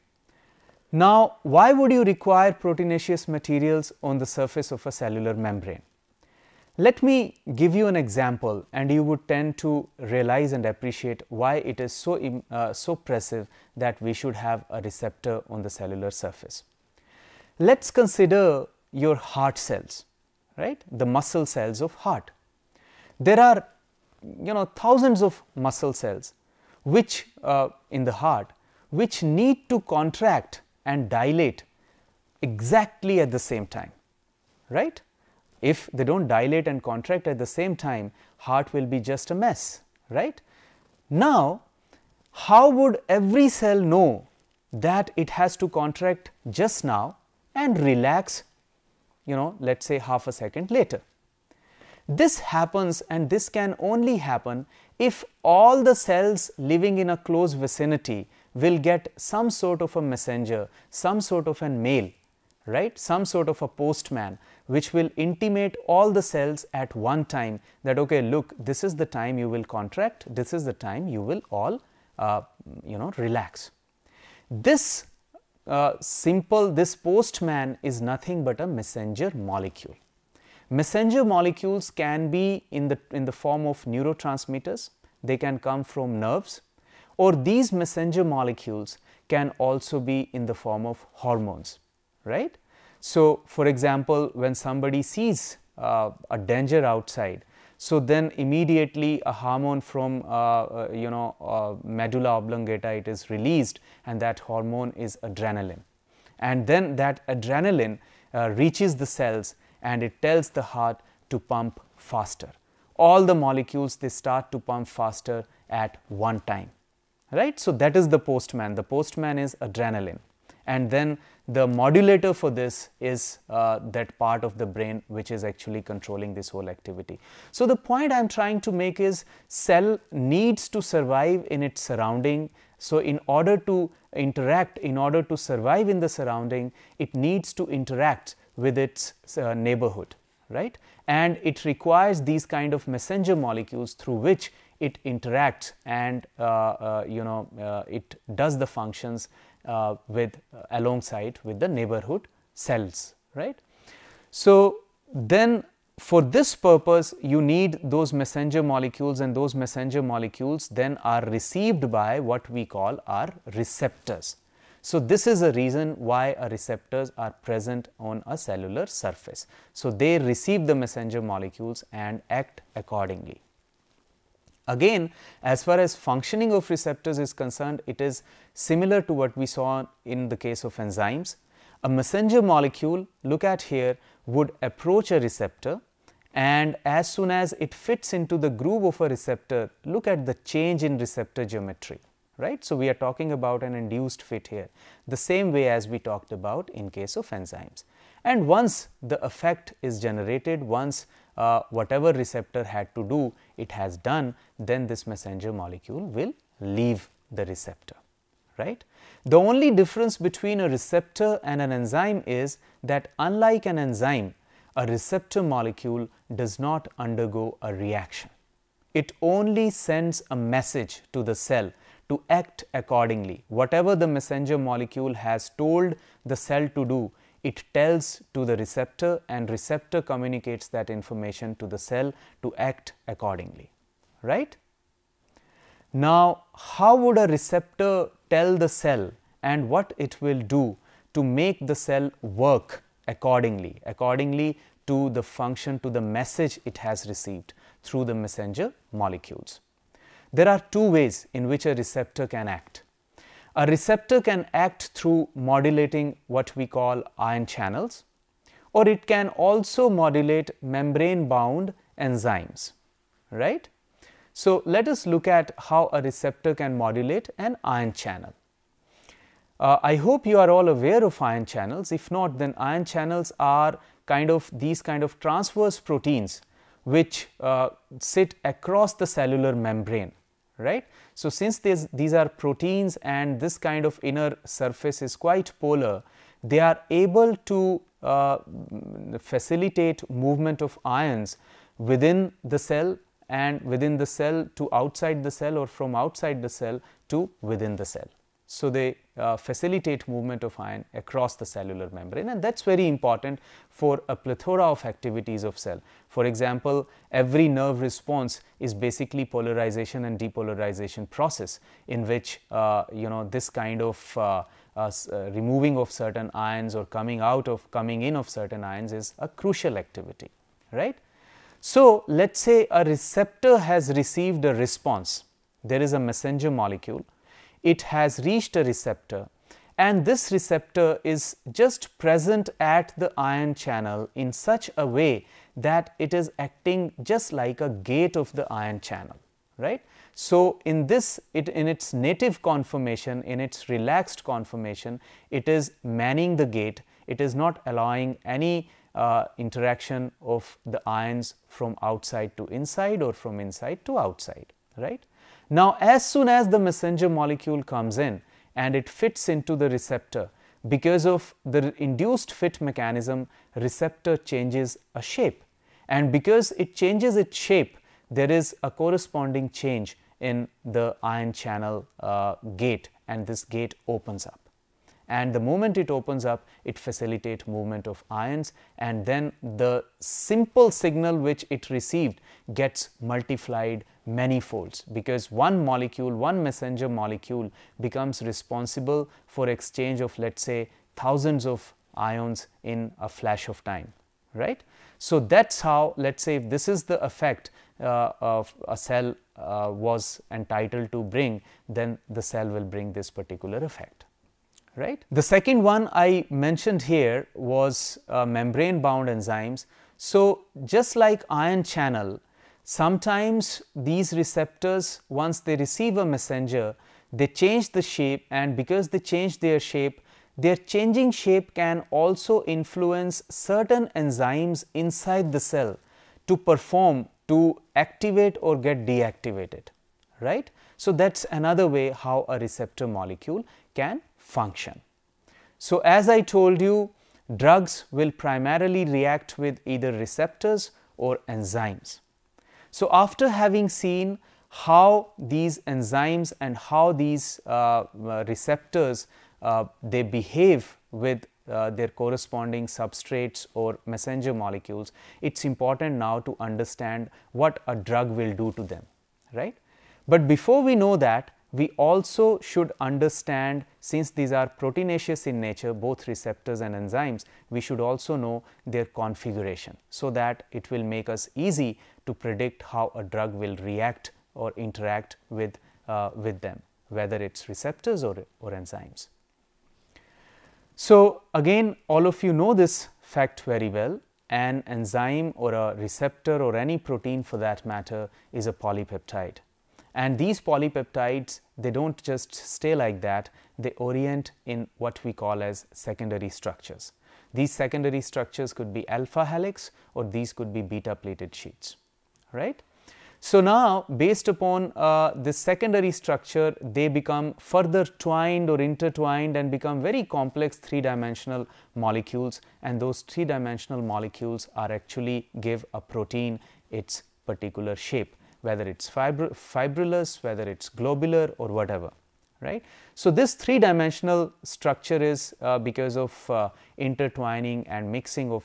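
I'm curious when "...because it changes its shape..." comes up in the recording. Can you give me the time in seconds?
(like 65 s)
366 s.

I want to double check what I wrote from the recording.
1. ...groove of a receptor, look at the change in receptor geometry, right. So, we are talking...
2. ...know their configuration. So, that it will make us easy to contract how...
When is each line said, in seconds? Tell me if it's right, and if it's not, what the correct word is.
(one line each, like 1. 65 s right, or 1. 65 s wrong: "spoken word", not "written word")
1. 188 s right
2. 468 s wrong: "predict", not "contract".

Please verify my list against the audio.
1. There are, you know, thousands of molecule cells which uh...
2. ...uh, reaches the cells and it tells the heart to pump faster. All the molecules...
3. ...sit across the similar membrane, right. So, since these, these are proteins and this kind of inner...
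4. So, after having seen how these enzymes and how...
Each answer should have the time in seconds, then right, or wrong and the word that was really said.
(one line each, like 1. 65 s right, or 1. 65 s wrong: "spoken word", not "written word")
1. 23 s wrong: "muscle", not "molecule"
2. 108 s right
3. 277 s wrong: "cellular", not "similar"
4. 442 s right.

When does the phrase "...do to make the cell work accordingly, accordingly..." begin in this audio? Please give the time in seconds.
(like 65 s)
240 s.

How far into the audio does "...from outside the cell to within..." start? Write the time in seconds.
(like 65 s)
295 s.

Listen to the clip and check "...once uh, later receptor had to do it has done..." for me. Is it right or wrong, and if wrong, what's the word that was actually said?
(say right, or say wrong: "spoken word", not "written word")
wrong: "whatever", not "later".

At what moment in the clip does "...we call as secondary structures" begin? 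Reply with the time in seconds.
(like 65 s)
495 s.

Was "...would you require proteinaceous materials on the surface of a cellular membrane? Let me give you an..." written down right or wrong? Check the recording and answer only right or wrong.
right.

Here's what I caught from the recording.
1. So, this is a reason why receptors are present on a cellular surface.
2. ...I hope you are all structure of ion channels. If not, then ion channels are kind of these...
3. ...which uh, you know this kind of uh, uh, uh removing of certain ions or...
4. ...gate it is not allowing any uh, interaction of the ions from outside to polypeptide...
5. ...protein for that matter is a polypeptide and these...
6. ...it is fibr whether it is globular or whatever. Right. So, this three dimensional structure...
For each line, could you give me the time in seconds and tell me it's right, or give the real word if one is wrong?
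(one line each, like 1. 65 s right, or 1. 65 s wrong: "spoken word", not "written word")
1. 164 s right
2. 269 s wrong: "aware", not "structure"
3. 312 s right
4. 346 s wrong: "inside", not "polypeptide"
5. 486 s right
6. 518 s right.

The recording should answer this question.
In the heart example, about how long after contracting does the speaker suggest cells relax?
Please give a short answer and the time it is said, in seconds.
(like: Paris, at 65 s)
Half a second, at 49 s.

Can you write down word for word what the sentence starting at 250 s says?
There are two ways in which a receptor can act.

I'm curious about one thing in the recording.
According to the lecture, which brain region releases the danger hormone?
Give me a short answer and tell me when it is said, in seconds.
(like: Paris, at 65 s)
Medulla oblongata, at 101 s.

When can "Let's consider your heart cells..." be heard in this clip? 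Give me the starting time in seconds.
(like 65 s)
17 s.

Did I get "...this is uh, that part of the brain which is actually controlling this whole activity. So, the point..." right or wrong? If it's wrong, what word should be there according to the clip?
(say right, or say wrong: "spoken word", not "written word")
right.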